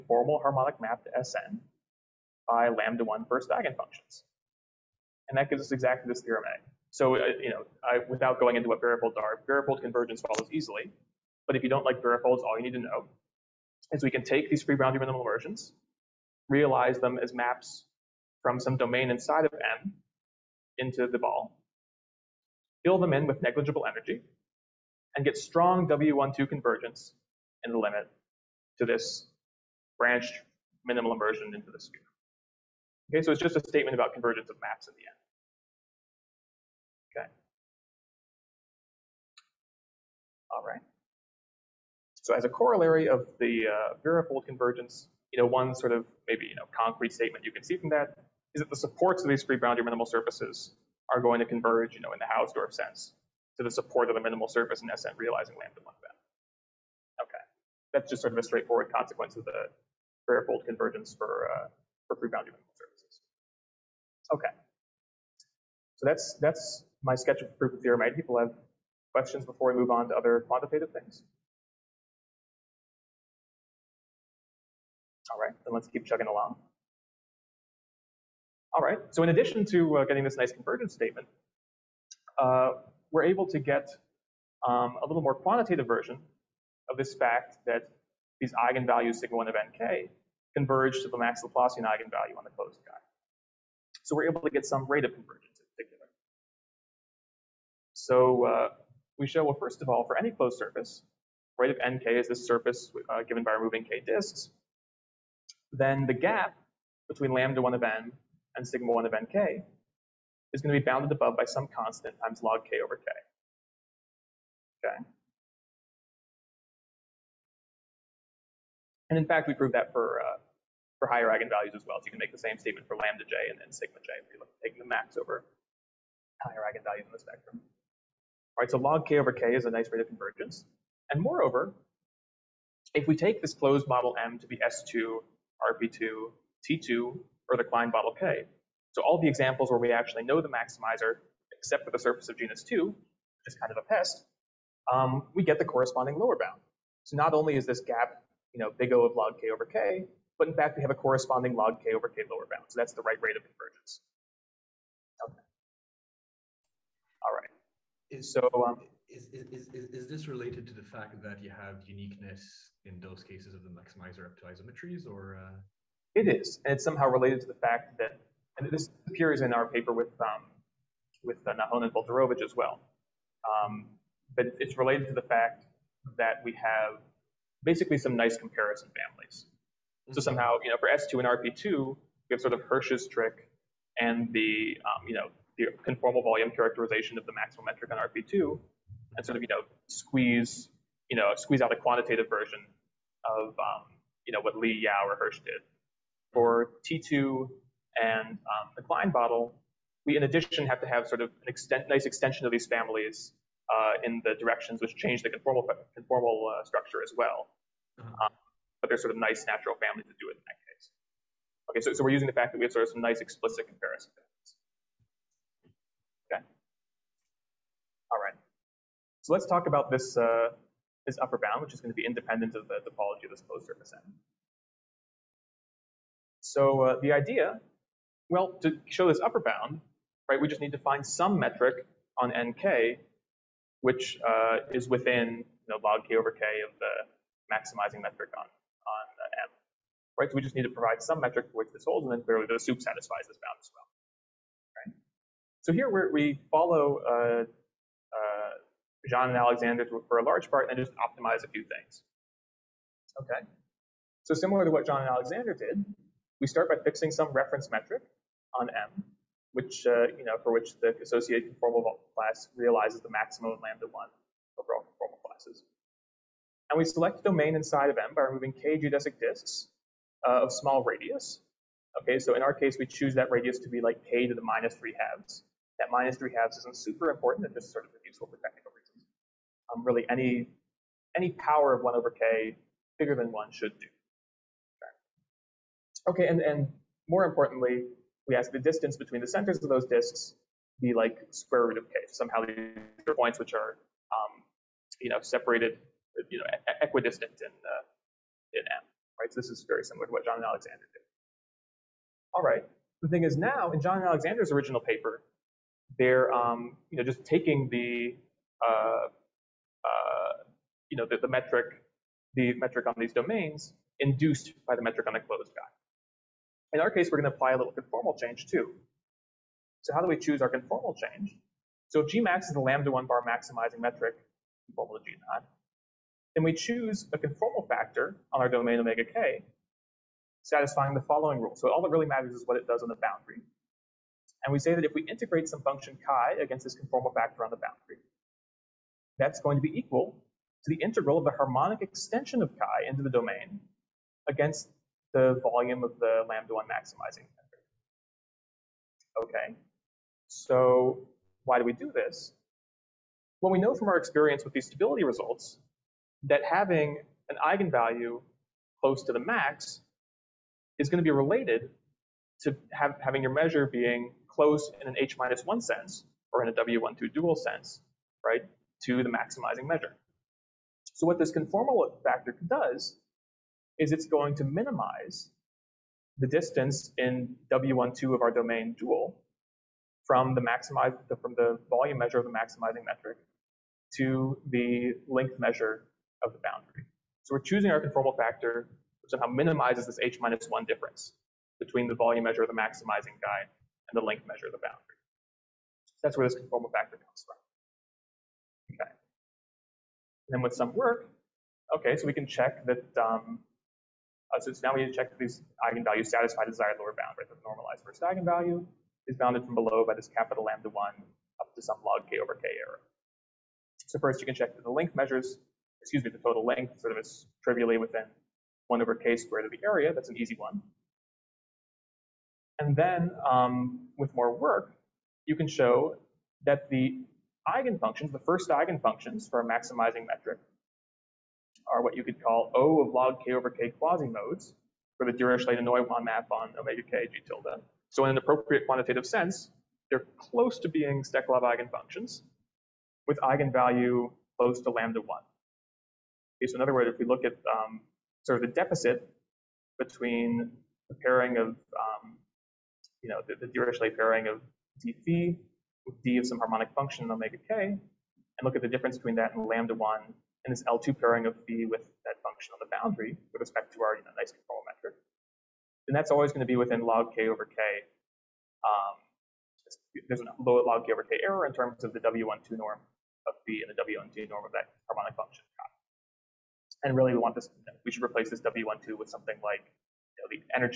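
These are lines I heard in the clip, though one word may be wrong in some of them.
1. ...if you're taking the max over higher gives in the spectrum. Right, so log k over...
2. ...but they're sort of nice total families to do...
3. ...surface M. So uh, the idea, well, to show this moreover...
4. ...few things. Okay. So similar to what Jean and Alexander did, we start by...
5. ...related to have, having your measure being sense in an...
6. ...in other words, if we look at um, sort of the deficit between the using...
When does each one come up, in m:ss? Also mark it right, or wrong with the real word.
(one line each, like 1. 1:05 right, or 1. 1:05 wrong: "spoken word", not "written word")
1. 2:04 wrong: "eigenvalues", not "gives"
2. 3:28 wrong: "natural", not "total"
3. 3:43 wrong: "upper", not "moreover"
4. 4:11 right
5. 6:01 wrong: "close", not "sense"
6. 7:26 wrong: "pairing", not "using".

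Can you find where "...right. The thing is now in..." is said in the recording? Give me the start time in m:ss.
5:02.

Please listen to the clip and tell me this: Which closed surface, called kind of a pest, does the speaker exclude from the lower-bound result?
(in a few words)
surface of genus 2.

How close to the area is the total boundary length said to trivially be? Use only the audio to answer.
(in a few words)
1 over k squared.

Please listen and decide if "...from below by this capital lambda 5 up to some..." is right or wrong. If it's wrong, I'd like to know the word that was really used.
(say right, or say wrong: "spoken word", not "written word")
wrong: "1", not "5".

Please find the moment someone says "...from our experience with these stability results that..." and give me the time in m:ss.
5:53.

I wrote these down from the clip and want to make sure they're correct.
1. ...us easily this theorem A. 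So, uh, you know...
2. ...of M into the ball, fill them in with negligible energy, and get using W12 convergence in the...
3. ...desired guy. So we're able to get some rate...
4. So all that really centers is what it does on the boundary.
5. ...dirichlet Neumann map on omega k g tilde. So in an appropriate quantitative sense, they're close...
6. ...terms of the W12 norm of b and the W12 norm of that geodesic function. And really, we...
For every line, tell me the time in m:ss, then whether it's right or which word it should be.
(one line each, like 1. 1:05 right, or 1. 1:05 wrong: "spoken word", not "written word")
1. 0:05 wrong: "exactly", not "easily"
2. 0:19 wrong: "strong", not "using"
3. 1:32 wrong: "closed", not "desired"
4. 5:31 wrong: "matters", not "centers"
5. 7:15 right
6. 7:51 wrong: "harmonic", not "geodesic".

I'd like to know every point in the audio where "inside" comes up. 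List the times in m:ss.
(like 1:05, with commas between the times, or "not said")
0:19, 4:27.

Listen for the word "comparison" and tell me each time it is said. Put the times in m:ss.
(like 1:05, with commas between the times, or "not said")
2:58, 3:33.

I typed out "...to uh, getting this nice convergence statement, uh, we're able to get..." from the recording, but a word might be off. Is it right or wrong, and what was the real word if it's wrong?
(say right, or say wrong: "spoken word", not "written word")
right.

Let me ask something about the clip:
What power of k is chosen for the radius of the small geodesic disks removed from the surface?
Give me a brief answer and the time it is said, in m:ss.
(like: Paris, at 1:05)
k to the minus 3/2, at 4:34.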